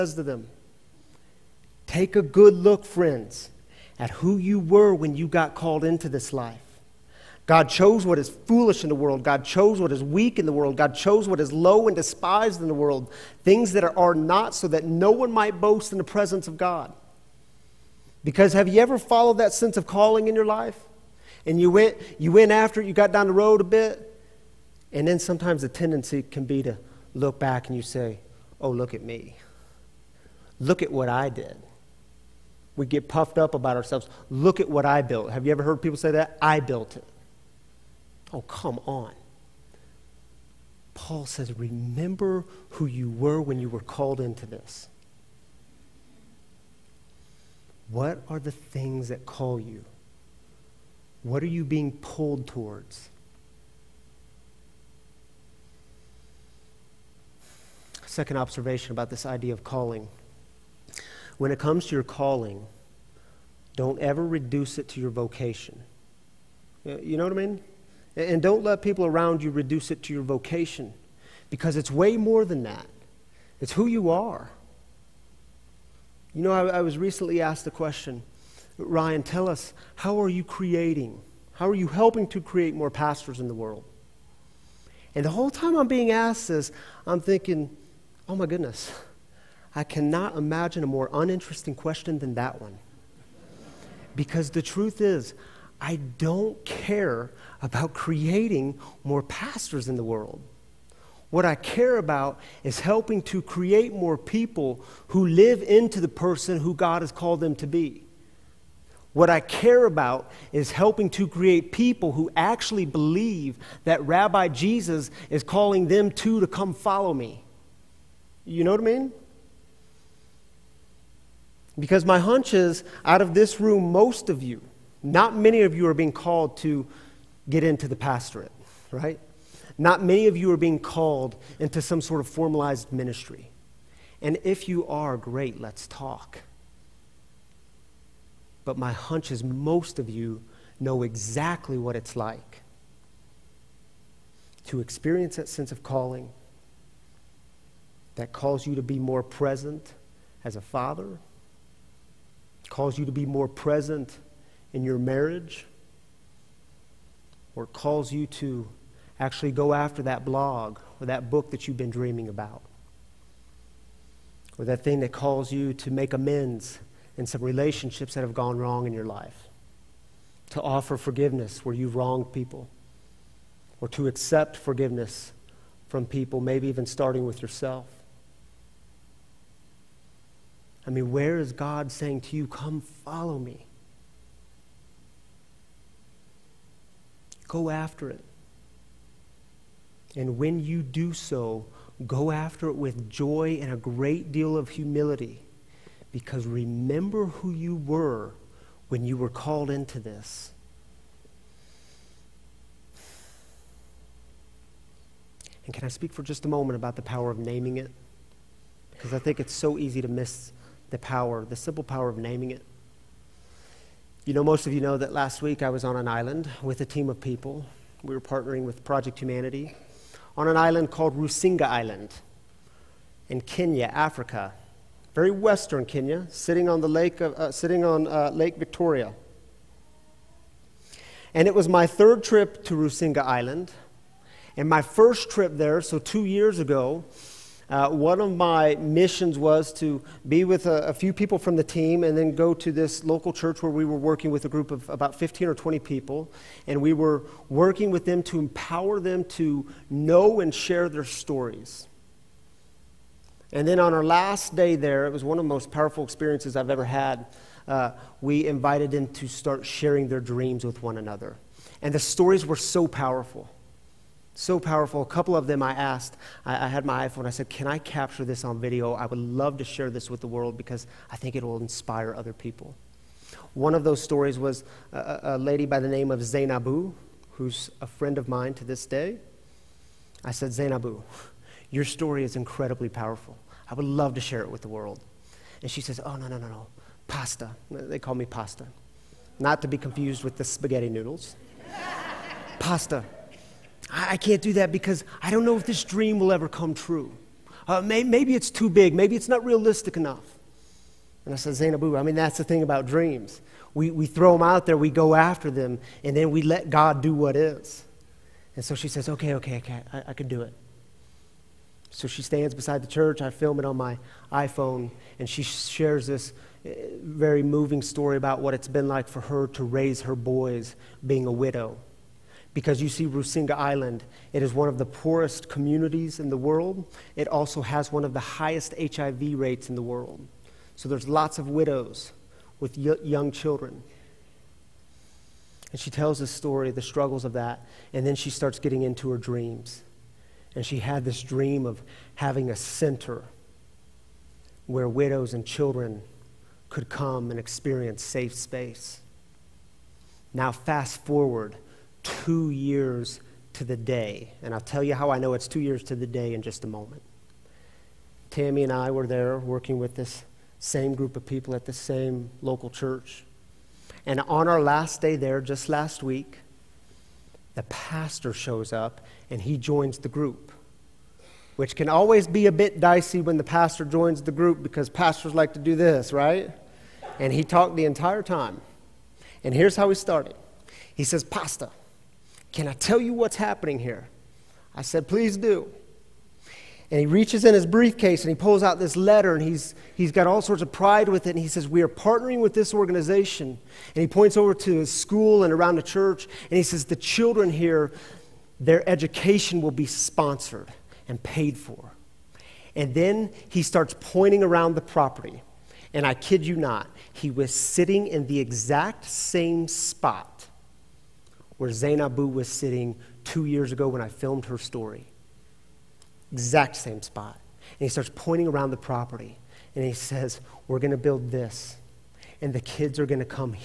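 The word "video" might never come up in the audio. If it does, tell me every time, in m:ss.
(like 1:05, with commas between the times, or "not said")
4:28.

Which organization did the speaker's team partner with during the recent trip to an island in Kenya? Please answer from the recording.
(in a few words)
Project Humanity.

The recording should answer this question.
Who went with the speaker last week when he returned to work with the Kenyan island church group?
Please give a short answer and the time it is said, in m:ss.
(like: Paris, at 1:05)
Tammy, at 5:58.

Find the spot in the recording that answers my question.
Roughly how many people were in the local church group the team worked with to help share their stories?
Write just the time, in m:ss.
4:05.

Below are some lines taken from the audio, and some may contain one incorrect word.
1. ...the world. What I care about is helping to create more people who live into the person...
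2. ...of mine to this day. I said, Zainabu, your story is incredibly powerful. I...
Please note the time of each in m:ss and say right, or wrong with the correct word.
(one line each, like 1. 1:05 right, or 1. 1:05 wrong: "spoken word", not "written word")
1. 1:39 right
2. 4:38 right.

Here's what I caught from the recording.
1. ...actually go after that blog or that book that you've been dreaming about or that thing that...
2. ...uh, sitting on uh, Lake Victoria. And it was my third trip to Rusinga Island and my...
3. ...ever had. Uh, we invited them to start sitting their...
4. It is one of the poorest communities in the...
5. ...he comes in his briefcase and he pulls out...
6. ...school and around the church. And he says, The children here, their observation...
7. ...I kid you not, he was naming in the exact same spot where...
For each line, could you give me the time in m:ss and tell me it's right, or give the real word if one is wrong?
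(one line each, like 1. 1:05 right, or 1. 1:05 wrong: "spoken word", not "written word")
1. 2:39 right
2. 3:47 right
3. 4:16 wrong: "sharing", not "sitting"
4. 5:24 right
5. 6:26 wrong: "reaches", not "comes"
6. 6:34 wrong: "education", not "observation"
7. 6:46 wrong: "sitting", not "naming".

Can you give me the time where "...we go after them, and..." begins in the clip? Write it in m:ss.
5:04.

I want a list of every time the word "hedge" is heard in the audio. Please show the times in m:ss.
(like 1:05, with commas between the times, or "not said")
not said.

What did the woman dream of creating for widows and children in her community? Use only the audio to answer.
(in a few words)
a center.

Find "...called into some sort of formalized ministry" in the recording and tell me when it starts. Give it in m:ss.
2:10.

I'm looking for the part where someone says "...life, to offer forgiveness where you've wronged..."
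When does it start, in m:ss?
2:49.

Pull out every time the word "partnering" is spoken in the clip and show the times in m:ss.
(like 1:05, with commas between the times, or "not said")
3:38, 6:31.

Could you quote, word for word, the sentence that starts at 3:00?
I mean, where is God saying to you, Come follow me?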